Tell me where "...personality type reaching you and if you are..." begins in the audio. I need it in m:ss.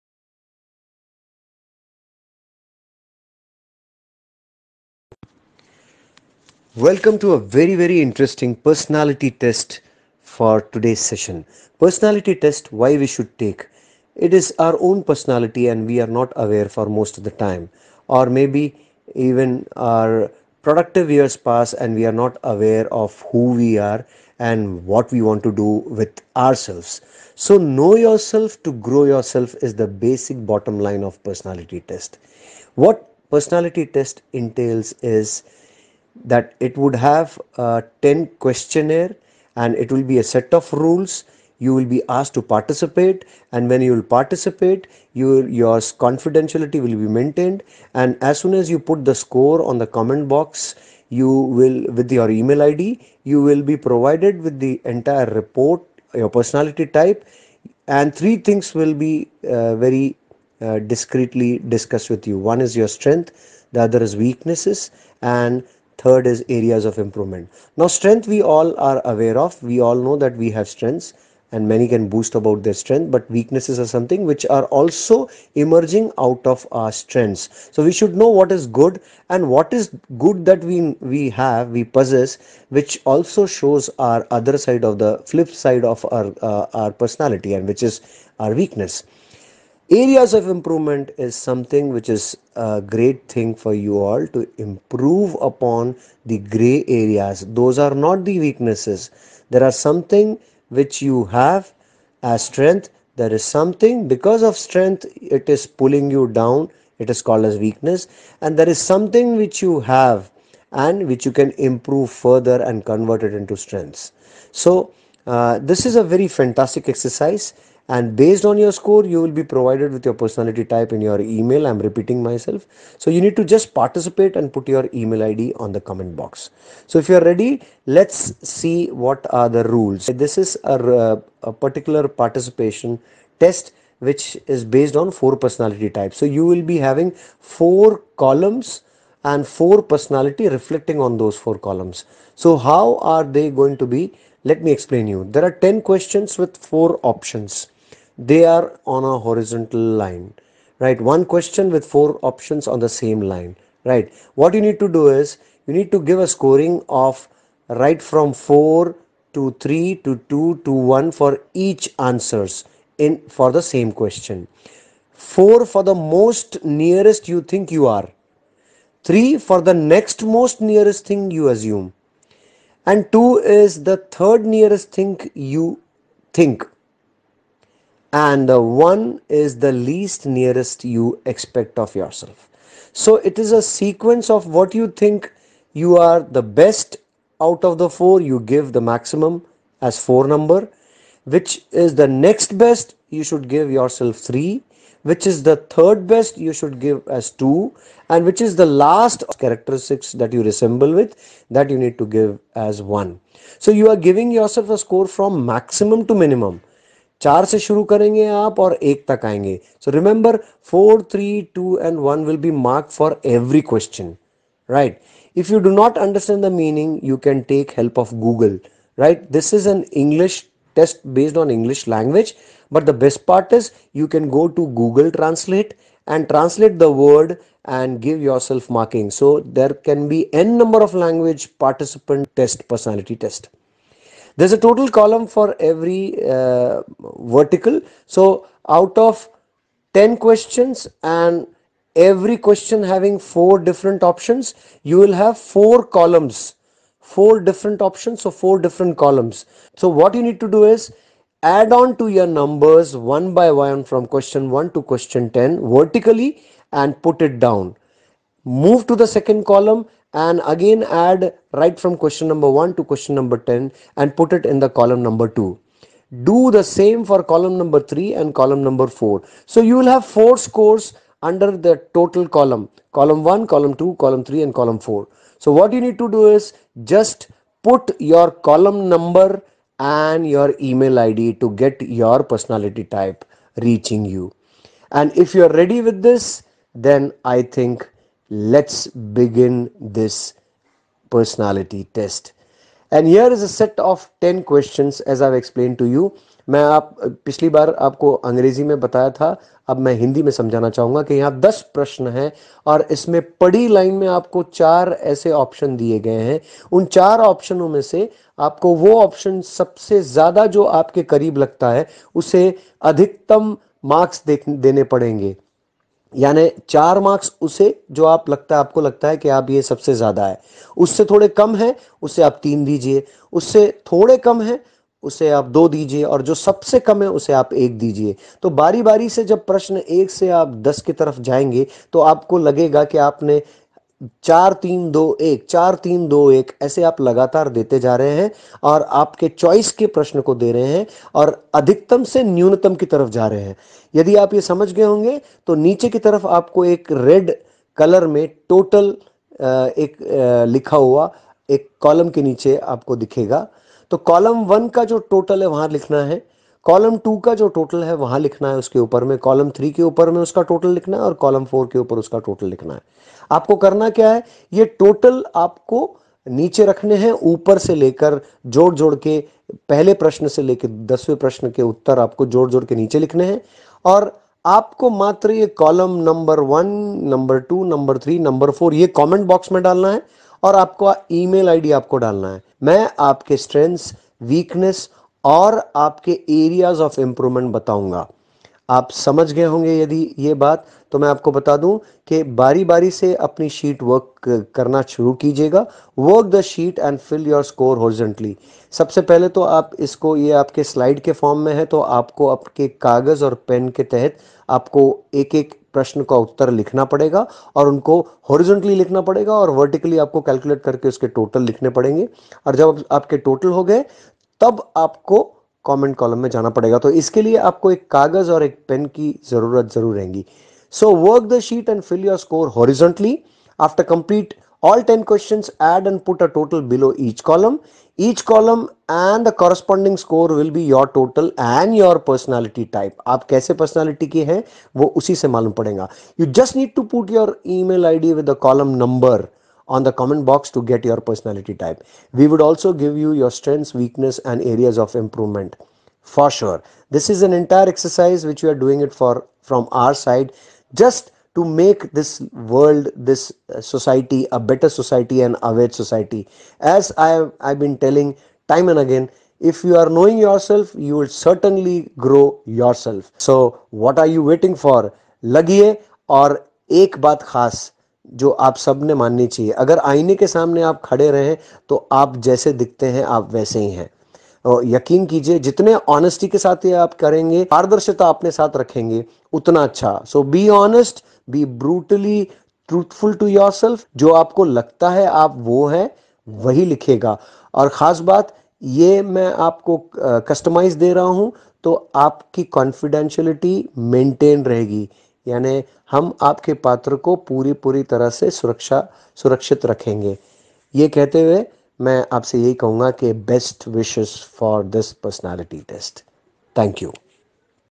4:42.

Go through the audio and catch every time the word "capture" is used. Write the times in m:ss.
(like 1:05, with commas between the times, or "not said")
not said.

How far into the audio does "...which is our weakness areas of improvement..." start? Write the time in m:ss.
1:27.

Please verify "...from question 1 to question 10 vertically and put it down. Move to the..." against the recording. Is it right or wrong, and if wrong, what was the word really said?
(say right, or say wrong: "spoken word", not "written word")
right.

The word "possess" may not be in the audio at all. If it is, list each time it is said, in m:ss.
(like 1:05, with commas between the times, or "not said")
1:21.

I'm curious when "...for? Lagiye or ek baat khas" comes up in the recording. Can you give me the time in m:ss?
7:44.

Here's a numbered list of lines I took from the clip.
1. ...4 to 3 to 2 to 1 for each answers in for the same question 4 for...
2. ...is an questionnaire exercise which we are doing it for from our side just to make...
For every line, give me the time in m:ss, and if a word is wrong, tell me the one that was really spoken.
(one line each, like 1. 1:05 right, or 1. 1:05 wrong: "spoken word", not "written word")
1. 2:38 right
2. 7:27 wrong: "entire", not "questionnaire".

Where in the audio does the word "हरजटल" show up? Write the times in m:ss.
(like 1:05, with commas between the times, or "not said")
6:37, 7:02.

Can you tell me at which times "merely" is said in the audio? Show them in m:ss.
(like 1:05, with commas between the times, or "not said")
not said.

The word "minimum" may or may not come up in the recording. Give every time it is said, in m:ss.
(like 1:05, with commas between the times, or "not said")
3:26.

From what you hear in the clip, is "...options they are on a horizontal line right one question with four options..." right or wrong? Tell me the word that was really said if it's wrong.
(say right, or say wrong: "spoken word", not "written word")
right.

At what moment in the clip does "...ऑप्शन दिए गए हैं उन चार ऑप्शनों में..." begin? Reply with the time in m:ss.
5:05.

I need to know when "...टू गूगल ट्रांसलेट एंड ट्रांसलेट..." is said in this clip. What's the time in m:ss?
3:44.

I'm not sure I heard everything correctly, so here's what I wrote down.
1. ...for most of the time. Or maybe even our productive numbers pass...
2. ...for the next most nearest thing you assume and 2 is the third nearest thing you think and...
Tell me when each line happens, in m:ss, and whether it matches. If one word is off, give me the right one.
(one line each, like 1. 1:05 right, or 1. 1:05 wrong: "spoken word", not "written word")
1. 0:16 wrong: "years", not "numbers"
2. 2:49 right.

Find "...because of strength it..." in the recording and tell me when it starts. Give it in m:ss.
1:44.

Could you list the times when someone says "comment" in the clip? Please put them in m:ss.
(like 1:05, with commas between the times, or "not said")
0:49, 2:05, 7:19.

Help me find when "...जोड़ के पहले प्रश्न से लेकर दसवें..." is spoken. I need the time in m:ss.
6:08.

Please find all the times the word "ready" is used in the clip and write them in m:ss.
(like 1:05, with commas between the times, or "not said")
2:07, 4:45.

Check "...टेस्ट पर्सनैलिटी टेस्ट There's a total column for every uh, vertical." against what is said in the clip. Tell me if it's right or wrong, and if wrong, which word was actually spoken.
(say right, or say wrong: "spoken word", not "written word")
right.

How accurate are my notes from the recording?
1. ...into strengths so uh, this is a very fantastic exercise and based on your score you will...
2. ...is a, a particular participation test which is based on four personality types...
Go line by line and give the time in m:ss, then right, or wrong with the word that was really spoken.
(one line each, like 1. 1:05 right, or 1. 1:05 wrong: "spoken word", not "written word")
1. 1:53 right
2. 2:10 right.